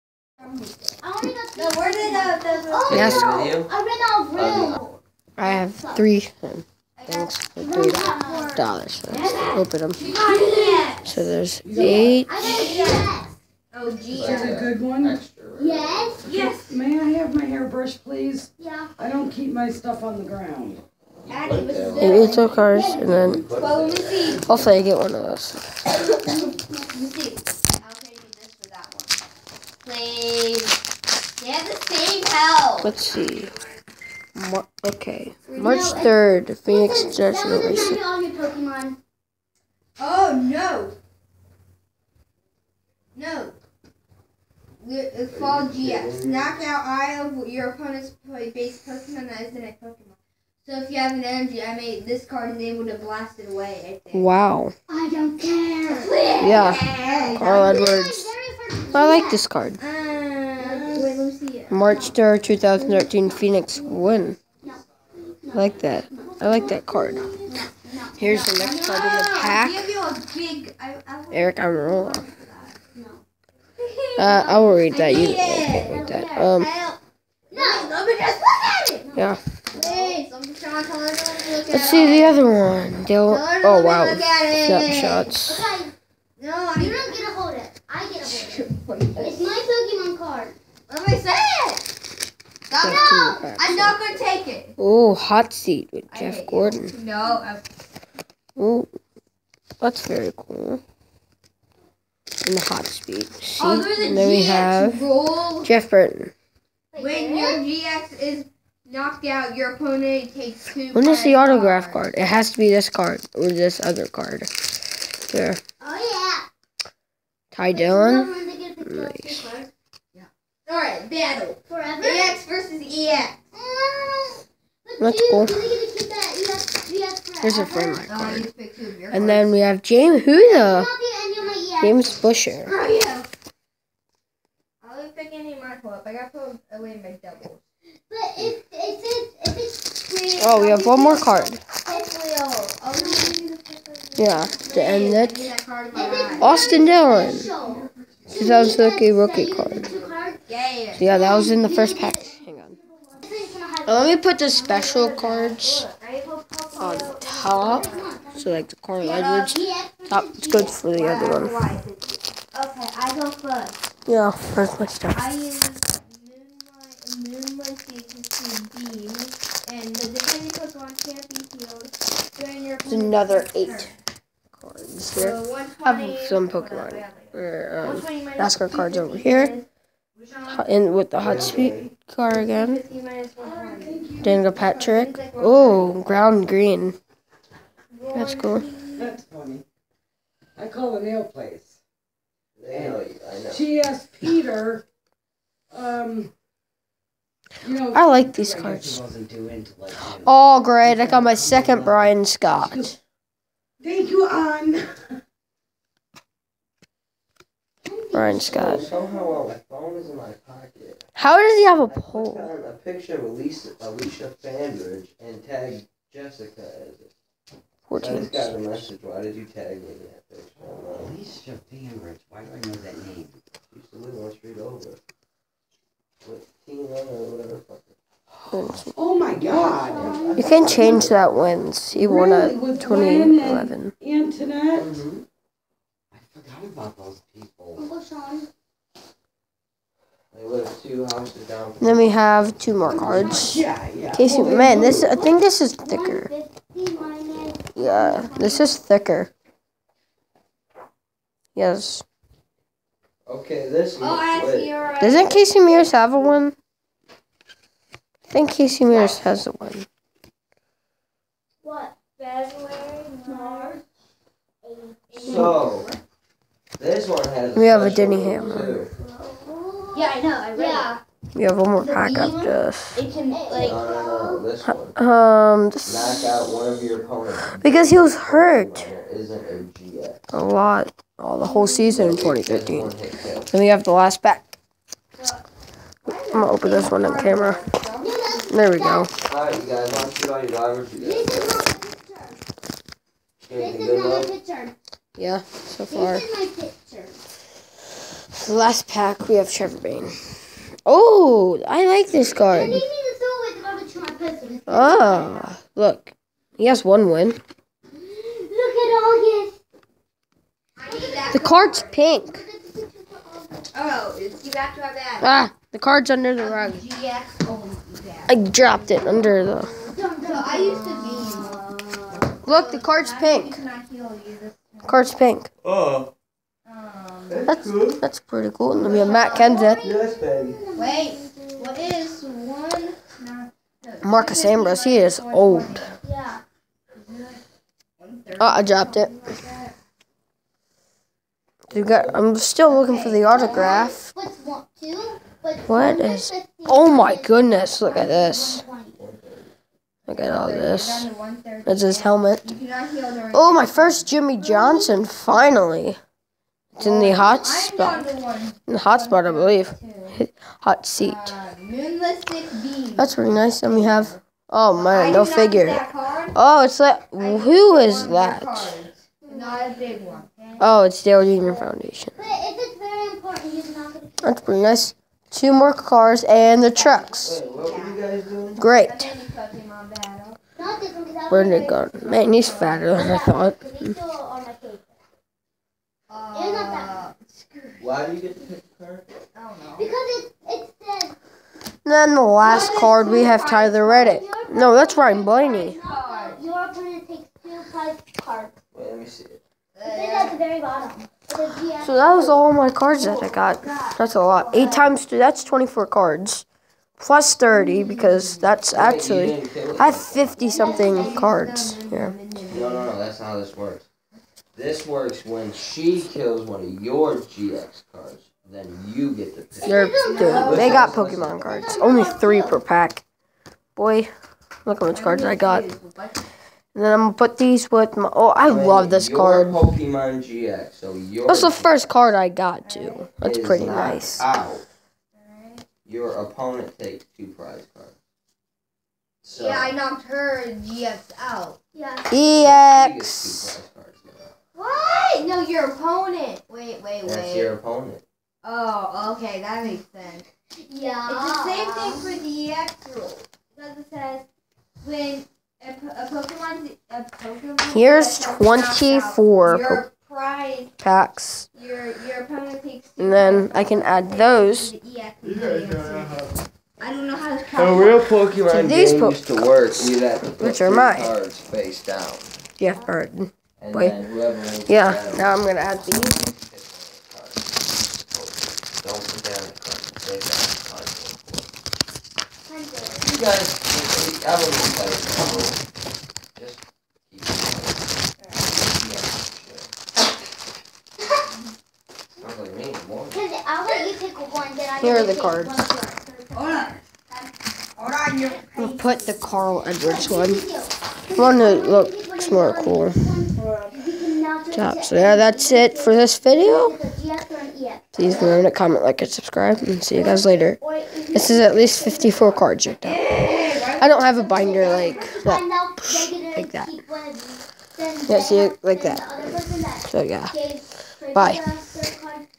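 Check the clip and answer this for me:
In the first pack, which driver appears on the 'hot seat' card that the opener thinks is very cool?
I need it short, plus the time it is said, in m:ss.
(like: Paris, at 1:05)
Jeff Gordon, at 1:36.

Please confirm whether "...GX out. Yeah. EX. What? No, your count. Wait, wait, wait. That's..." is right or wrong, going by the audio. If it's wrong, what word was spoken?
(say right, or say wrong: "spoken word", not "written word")
wrong: "opponent", not "count".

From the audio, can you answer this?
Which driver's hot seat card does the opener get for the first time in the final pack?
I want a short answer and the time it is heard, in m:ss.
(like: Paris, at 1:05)
Jimmie Johnson, at 5:54.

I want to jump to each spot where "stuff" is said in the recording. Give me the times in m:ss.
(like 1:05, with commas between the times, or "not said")
0:19, 2:44.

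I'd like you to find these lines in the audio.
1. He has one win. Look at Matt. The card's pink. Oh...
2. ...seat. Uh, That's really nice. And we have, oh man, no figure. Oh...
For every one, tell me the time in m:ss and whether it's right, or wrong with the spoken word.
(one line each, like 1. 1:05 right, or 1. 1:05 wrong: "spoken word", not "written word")
1. 5:06 wrong: "August", not "Matt"
2. 6:00 right.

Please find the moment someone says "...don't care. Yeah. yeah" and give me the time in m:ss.
0:55.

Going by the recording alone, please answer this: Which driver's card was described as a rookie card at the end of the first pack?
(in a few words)
Austin Dillon.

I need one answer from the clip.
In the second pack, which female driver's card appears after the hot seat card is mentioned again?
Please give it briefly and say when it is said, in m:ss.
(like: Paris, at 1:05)
Danica Patrick, at 3:04.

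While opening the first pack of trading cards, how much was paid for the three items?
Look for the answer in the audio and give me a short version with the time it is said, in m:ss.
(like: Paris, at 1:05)
3 dollars, at 0:07.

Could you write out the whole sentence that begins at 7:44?
The I don't know how to count.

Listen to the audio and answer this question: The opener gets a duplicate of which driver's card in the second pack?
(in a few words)
Brian Scott.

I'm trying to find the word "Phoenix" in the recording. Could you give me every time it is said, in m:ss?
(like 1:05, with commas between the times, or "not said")
0:36, 1:03.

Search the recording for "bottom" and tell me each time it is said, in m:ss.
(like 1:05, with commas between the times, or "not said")
6:40.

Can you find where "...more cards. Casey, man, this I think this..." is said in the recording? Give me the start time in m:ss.
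4:02.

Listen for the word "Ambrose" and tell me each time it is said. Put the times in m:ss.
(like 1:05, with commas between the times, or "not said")
5:34.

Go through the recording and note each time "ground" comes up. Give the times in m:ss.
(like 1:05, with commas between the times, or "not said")
0:20, 3:06.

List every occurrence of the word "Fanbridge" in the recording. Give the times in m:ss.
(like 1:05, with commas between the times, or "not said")
3:34, 3:41.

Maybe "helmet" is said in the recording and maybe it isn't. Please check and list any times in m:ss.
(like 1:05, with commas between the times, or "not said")
5:52.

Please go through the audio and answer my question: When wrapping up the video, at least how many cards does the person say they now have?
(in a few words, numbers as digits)
54.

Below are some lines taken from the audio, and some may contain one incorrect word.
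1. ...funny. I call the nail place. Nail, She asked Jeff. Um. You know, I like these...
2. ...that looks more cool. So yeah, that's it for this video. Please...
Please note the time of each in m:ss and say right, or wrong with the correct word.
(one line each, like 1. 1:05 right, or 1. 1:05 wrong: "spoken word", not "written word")
1. 3:09 wrong: "Peter", not "Jeff"
2. 8:21 right.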